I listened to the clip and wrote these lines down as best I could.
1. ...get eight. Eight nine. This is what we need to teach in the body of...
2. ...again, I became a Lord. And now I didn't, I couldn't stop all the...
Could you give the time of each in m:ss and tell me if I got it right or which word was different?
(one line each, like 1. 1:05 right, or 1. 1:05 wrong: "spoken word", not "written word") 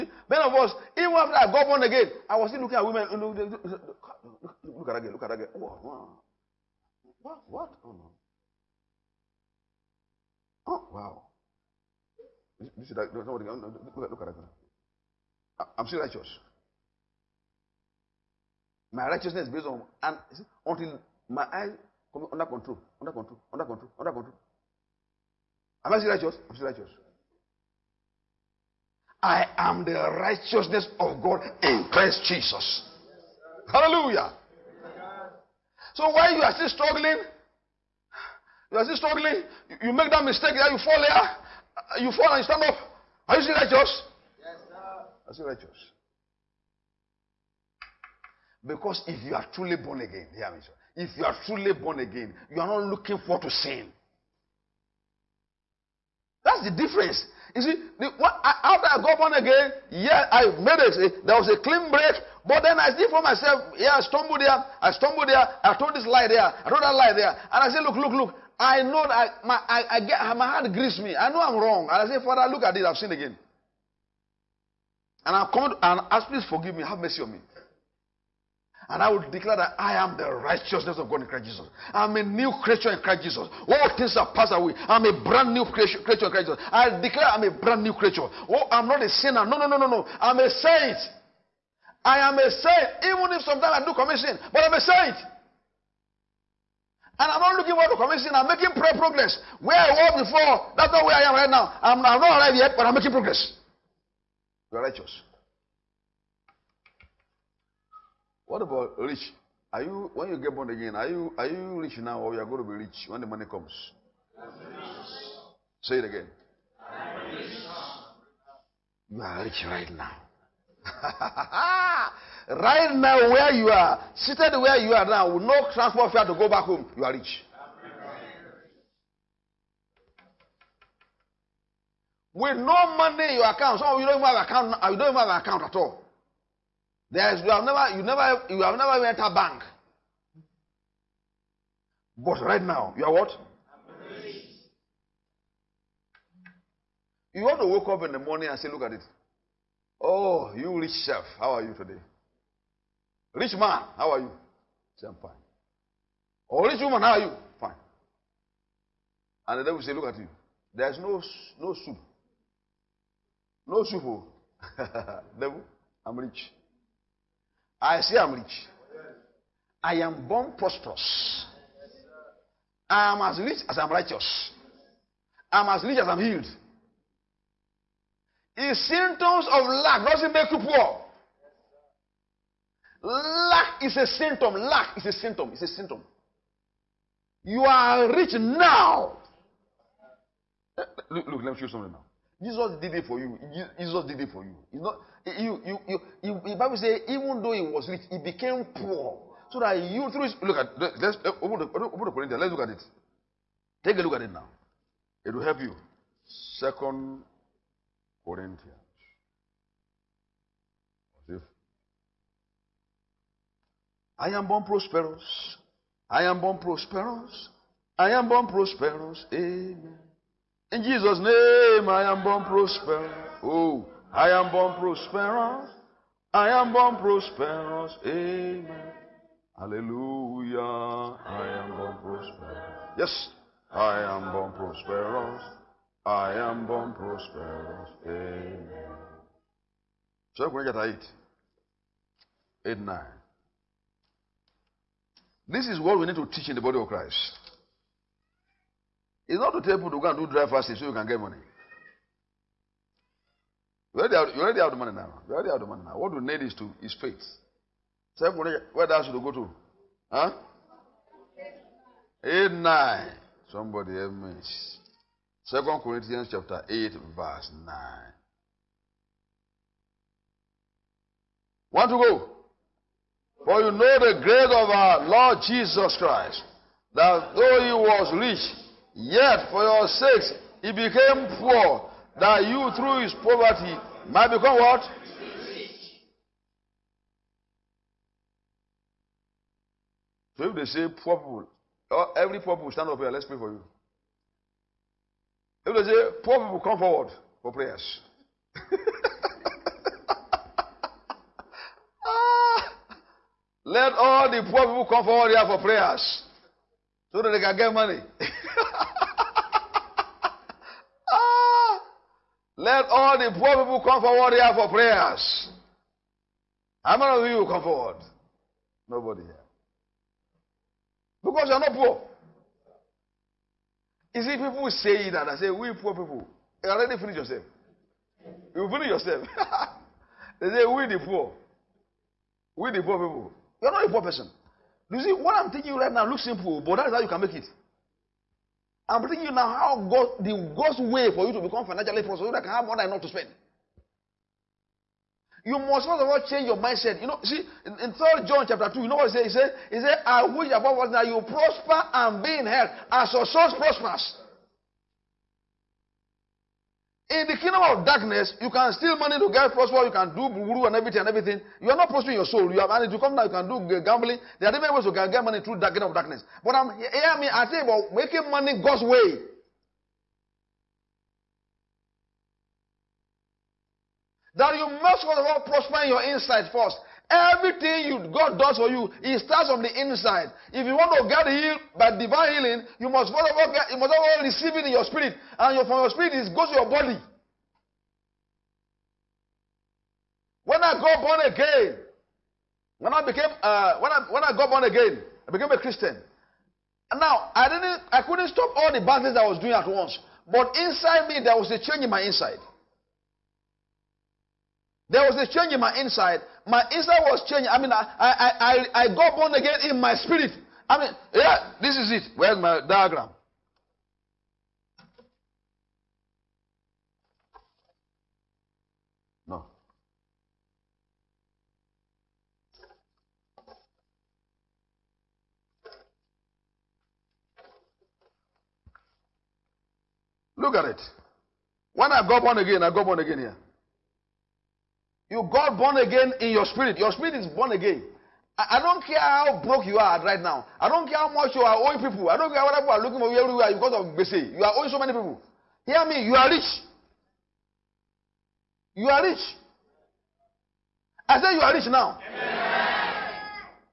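1. 4:00 right
2. 6:34 wrong: "Christian", not "Lord".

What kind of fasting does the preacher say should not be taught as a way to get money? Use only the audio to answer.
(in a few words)
dry fasting.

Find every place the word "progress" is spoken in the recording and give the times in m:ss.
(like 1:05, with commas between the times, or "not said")
1:38, 1:43.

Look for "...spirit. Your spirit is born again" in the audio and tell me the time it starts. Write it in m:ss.
7:16.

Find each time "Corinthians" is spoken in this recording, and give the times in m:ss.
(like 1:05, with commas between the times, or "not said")
3:22, 3:28, 4:25.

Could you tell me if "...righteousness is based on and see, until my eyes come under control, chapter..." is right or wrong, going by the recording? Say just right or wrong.
wrong.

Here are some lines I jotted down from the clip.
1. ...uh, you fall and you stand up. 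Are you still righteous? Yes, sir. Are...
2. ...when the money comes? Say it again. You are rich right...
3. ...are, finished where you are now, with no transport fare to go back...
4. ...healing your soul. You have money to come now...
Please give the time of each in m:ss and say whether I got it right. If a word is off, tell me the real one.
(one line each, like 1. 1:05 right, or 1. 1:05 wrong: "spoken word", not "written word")
1. 0:41 right
2. 1:53 right
3. 2:03 wrong: "seated", not "finished"
4. 6:01 wrong: "prospering", not "healing".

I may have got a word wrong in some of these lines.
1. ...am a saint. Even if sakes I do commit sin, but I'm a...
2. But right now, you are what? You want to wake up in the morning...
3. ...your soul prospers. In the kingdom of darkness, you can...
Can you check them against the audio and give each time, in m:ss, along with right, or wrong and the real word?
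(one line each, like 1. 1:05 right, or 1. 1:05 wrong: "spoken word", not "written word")
1. 1:32 wrong: "sometimes", not "sakes"
2. 2:22 right
3. 5:53 right.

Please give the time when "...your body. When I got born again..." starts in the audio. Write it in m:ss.
6:26.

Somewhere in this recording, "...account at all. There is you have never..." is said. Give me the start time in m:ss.
2:15.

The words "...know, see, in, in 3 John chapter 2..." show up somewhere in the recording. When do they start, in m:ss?
5:47.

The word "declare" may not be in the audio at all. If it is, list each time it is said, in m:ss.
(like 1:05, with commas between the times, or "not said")
1:19, 1:27.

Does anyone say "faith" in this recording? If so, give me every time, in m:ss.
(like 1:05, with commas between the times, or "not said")
4:16.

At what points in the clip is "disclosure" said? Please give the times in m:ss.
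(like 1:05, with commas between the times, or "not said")
not said.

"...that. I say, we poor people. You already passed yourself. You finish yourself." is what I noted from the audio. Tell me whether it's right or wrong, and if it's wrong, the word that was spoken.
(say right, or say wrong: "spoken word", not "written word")
wrong: "finished", not "passed".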